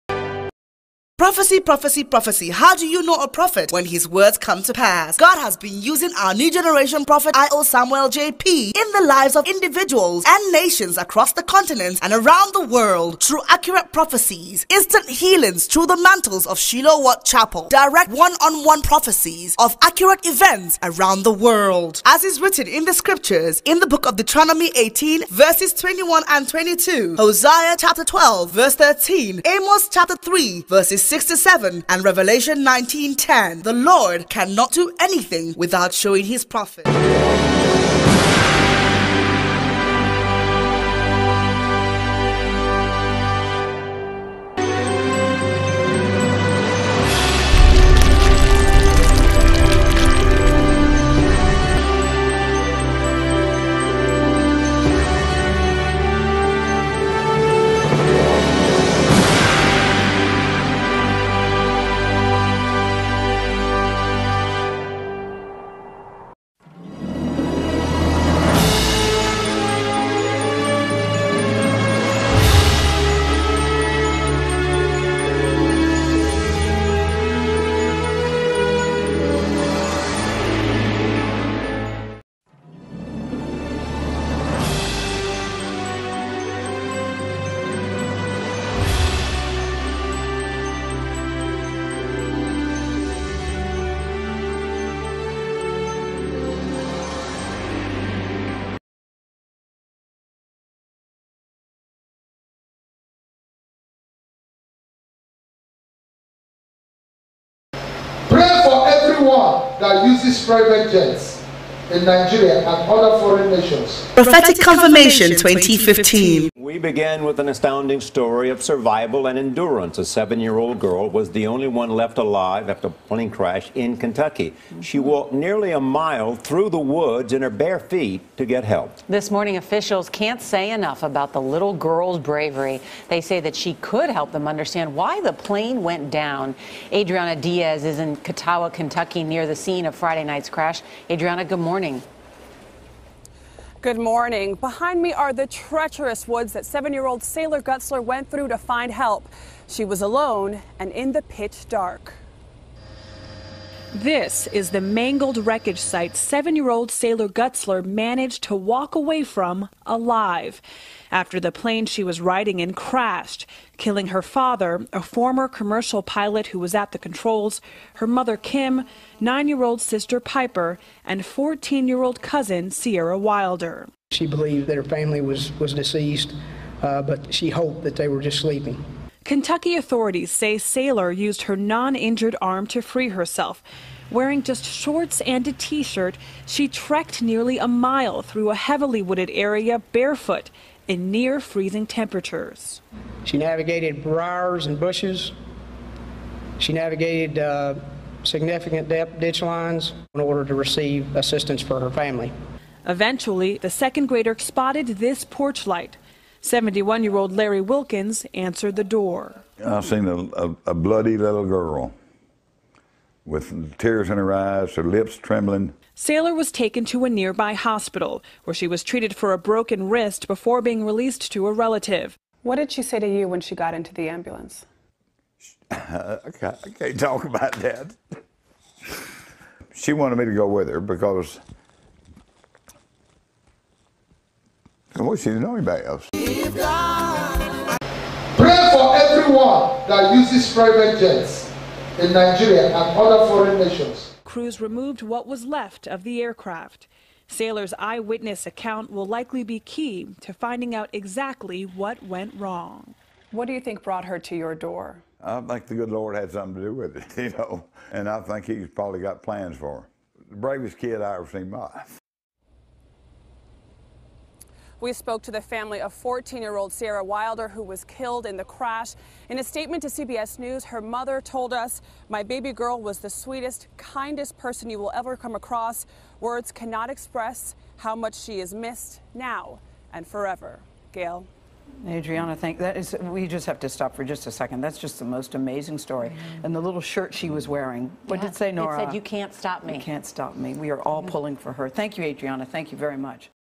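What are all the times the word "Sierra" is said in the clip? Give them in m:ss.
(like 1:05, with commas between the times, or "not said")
2:52, 4:26.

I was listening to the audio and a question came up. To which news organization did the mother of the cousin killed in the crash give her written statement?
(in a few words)
CBS News.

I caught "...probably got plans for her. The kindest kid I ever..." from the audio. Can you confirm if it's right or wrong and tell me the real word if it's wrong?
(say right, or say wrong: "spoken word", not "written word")
wrong: "bravest", not "kindest".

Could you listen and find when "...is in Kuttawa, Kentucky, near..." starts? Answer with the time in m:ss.
2:17.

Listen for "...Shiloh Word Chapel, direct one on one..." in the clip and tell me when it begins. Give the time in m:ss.
0:16.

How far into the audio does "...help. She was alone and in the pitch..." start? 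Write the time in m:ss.
2:28.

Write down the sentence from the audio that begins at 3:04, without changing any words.
Wearing just shorts and a t shirt, she trekked nearly a mile through a heavily wooded area barefoot in near freezing temperatures.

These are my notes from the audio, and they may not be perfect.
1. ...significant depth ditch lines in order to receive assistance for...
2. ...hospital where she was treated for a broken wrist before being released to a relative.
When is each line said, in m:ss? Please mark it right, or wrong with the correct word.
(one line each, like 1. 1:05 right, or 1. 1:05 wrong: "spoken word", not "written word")
1. 3:18 right
2. 3:37 right.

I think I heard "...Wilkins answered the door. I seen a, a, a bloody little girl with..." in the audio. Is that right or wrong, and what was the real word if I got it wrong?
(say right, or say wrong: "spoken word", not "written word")
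right.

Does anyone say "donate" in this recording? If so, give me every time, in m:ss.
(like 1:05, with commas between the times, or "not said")
not said.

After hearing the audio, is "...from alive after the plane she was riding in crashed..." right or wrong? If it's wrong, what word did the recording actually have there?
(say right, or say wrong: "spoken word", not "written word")
right.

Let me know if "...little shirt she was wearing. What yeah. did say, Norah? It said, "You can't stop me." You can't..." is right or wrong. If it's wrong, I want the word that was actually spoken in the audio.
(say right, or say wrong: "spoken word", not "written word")
right.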